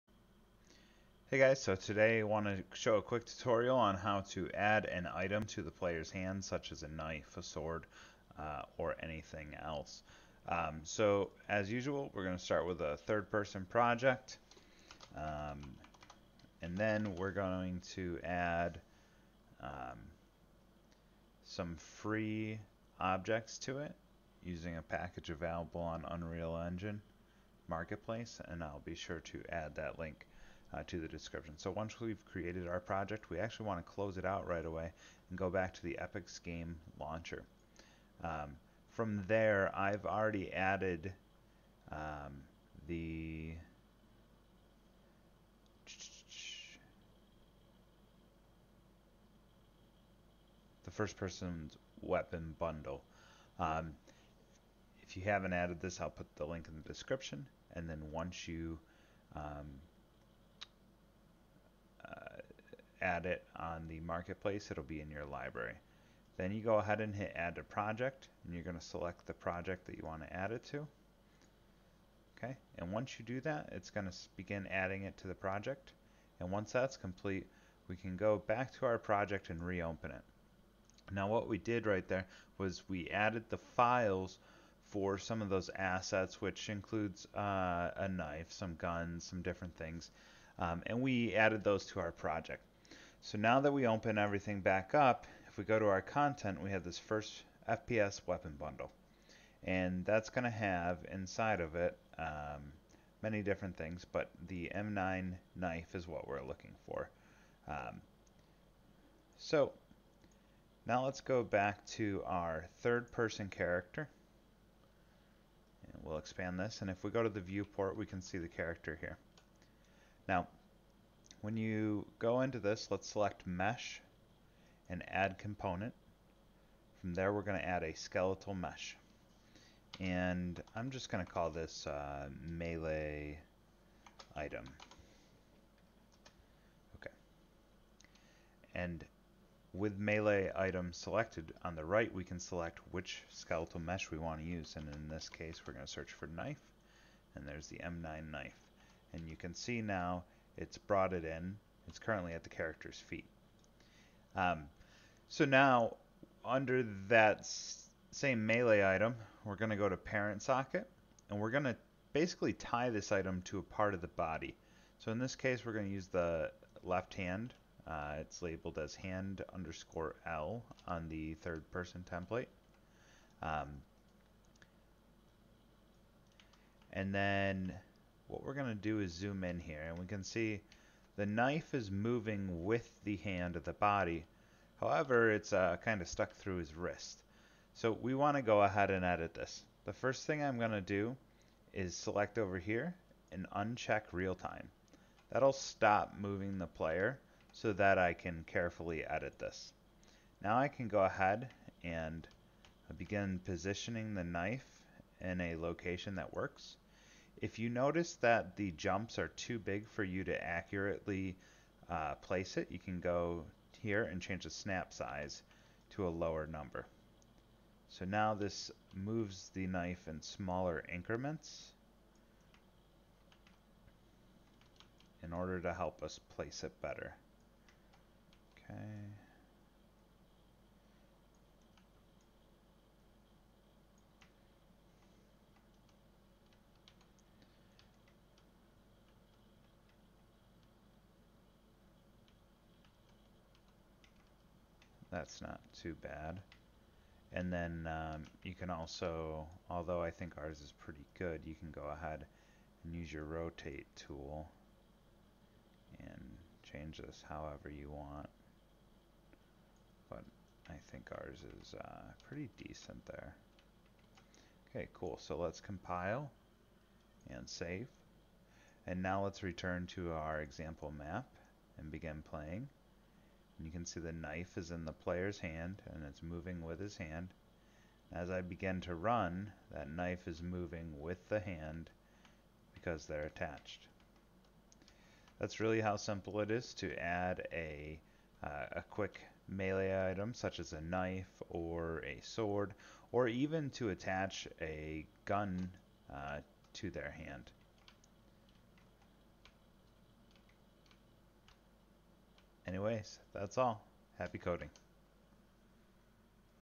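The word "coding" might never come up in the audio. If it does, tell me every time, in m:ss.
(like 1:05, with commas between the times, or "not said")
5:04.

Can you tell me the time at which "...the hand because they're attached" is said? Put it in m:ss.
4:41.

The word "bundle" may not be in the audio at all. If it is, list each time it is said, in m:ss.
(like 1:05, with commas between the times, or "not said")
0:52, 1:38.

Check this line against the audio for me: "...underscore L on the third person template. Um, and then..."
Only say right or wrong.
right.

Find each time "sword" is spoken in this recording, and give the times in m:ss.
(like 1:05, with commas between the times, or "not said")
0:07, 4:52.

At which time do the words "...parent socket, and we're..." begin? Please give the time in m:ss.
2:39.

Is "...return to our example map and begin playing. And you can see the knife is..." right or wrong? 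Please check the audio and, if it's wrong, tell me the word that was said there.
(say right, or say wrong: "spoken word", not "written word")
right.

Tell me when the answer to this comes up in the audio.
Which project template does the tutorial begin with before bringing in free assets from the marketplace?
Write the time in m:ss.
0:12.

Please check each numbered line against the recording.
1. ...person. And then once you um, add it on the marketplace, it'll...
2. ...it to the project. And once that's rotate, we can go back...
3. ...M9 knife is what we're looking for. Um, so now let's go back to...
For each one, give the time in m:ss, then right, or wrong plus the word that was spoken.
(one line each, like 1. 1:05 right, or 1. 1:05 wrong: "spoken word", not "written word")
1. 0:56 wrong: "description", not "person"
2. 1:15 wrong: "complete", not "rotate"
3. 1:44 right.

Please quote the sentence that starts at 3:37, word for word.
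So now this moves the knife in smaller increments in order to help us place it better.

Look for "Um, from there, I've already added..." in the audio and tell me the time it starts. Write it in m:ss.
0:38.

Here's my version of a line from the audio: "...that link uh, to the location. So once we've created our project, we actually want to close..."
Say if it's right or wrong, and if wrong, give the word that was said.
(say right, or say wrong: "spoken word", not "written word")
wrong: "description", not "location".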